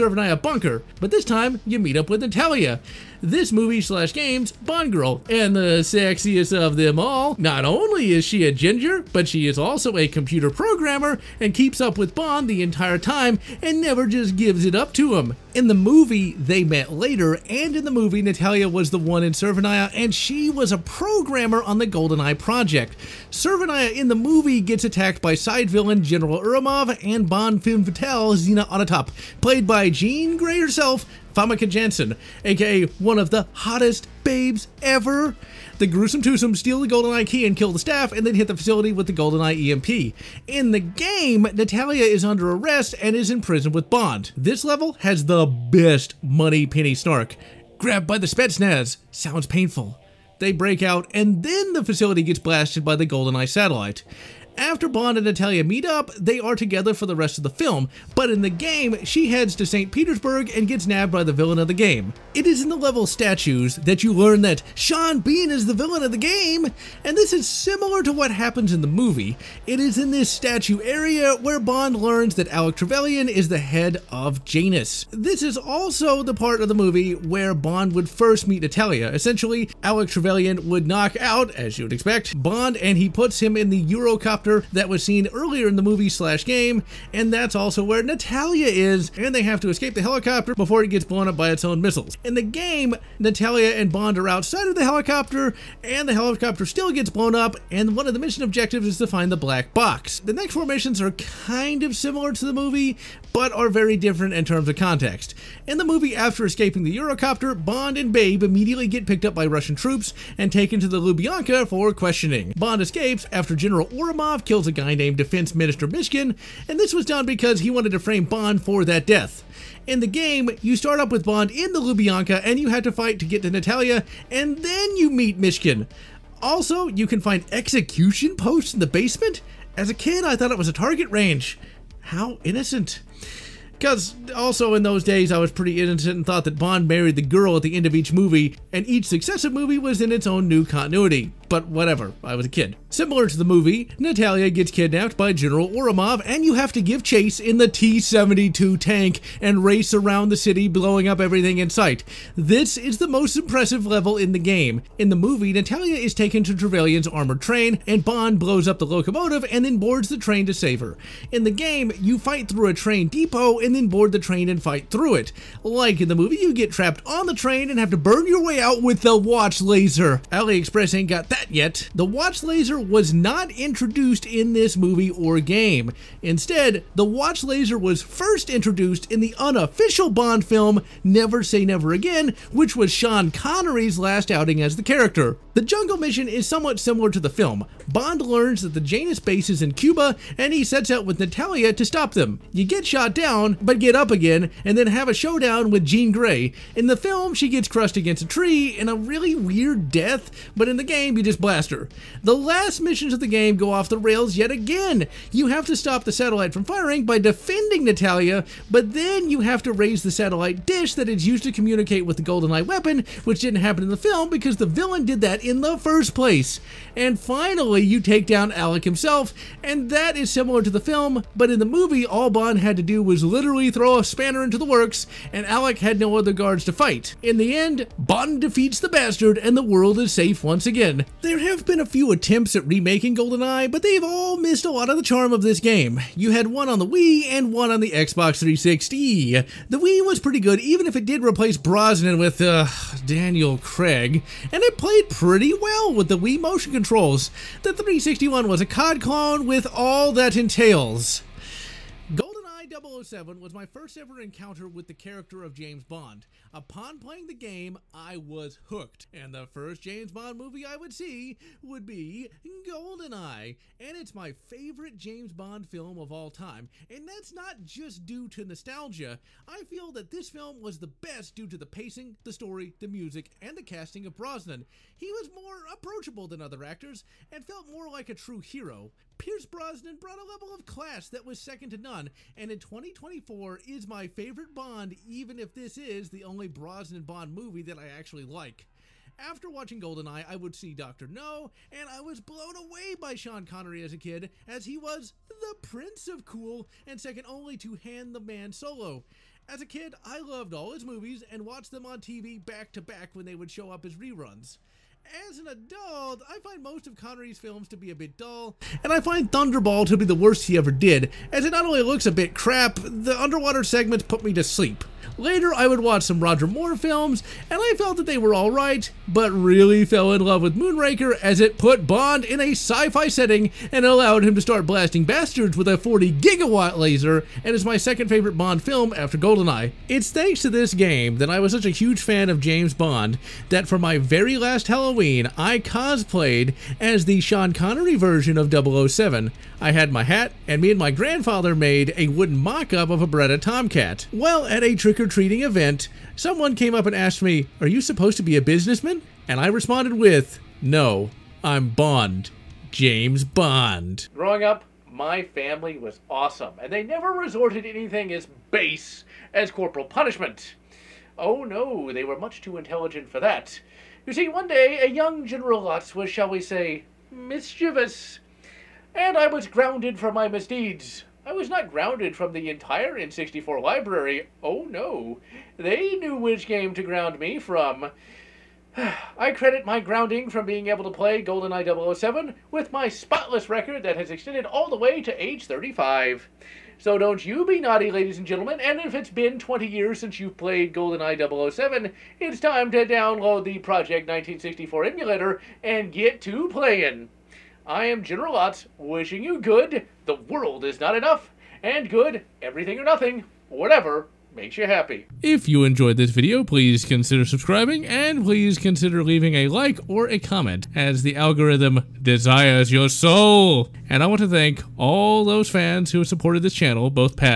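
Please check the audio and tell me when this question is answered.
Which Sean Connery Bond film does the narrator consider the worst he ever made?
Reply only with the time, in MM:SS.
05:09.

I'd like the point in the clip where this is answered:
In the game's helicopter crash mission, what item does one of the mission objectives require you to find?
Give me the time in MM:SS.
01:39.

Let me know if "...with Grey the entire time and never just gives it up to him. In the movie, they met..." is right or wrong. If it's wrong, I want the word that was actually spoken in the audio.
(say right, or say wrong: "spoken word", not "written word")
wrong: "Bond", not "Grey".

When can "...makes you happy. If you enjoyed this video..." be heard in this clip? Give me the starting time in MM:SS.
06:44.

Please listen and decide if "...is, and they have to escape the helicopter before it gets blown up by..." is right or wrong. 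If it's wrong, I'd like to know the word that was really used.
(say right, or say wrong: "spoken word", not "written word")
right.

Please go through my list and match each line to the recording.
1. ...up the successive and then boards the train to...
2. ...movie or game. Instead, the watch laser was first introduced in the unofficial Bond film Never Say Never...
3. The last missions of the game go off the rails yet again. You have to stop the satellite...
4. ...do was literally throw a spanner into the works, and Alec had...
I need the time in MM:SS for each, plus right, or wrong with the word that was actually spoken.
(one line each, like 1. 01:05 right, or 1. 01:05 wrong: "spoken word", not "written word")
1. 02:38 wrong: "locomotive", not "successive"
2. 02:54 right
3. 03:22 right
4. 03:42 right.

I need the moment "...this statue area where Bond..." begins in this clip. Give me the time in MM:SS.
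01:10.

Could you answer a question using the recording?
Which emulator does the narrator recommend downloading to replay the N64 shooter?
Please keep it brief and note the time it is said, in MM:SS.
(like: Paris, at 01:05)
Project 1964, at 06:33.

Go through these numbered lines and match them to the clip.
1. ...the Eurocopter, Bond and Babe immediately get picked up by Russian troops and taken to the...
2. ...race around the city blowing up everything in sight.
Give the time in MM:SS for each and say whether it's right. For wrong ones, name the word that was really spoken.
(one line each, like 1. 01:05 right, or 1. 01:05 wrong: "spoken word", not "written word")
1. 01:46 right
2. 02:29 right.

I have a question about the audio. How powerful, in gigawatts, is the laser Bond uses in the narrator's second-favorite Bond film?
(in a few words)
40 gigawatts.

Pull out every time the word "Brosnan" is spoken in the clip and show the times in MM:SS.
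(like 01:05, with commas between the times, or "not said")
04:01, 04:34, 04:39, 04:46.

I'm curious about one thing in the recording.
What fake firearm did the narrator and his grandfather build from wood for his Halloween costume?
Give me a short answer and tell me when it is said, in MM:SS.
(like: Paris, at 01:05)
Beretta Tomcat, at 05:43.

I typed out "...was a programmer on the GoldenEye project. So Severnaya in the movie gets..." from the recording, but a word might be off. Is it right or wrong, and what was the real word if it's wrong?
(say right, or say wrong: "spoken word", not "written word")
right.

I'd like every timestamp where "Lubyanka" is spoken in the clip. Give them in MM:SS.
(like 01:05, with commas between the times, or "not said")
01:51, 02:01.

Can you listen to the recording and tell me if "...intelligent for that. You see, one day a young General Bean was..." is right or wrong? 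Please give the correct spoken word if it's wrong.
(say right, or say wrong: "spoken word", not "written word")
wrong: "Lotz", not "Bean".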